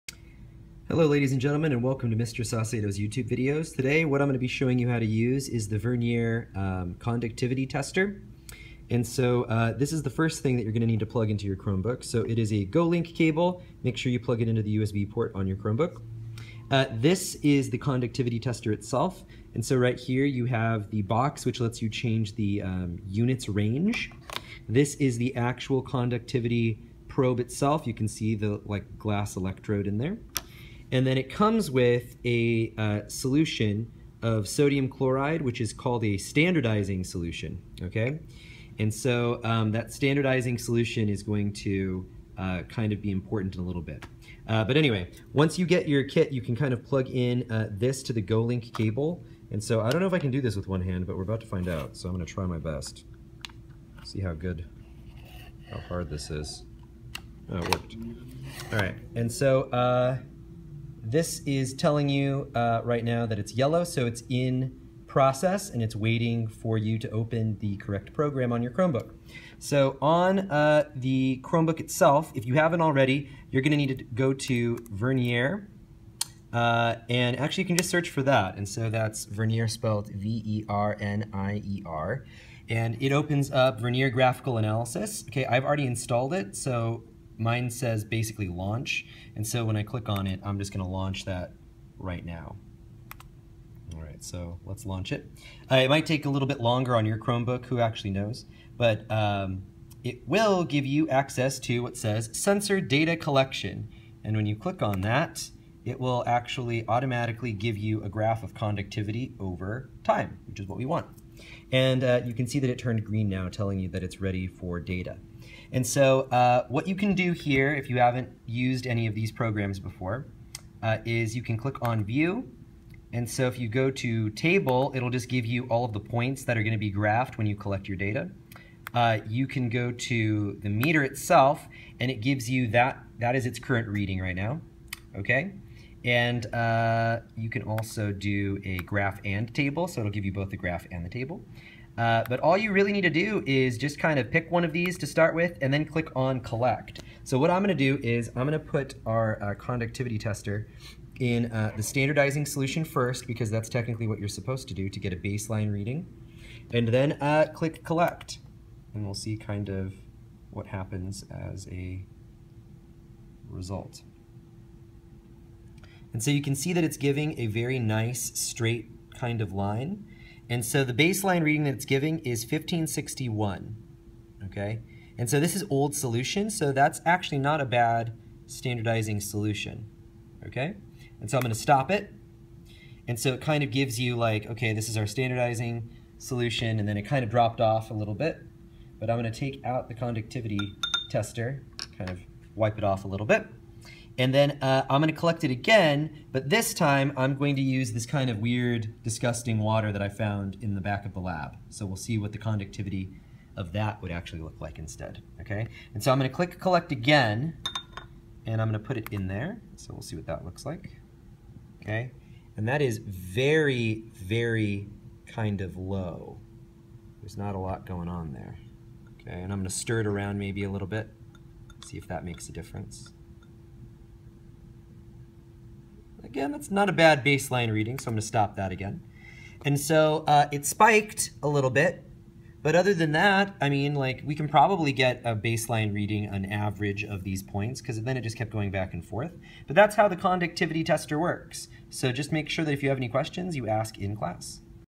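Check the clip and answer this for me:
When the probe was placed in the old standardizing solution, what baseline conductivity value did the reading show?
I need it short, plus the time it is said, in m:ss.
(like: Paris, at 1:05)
1561, at 2:52.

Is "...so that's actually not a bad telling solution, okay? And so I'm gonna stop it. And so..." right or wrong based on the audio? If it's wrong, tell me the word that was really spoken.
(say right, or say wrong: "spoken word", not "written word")
wrong: "standardizing", not "telling".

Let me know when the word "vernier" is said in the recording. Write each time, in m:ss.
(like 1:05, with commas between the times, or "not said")
0:05, 1:14, 1:19, 1:23.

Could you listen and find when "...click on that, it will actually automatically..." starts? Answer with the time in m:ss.
1:44.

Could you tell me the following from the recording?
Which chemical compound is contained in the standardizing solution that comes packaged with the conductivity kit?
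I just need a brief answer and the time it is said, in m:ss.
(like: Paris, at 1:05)
sodium chloride, at 0:34.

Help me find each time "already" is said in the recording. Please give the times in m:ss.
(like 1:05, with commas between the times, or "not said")
1:12, 1:25.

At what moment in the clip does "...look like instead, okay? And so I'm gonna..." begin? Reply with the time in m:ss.
3:24.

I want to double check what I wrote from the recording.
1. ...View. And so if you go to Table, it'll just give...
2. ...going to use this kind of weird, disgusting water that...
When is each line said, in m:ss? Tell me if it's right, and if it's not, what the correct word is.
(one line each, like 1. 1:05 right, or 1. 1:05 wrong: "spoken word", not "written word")
1. 2:02 right
2. 3:17 right.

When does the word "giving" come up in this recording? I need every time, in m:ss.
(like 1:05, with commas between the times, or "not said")
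2:46, 2:51.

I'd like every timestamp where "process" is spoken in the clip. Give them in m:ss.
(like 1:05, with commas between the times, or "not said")
1:05.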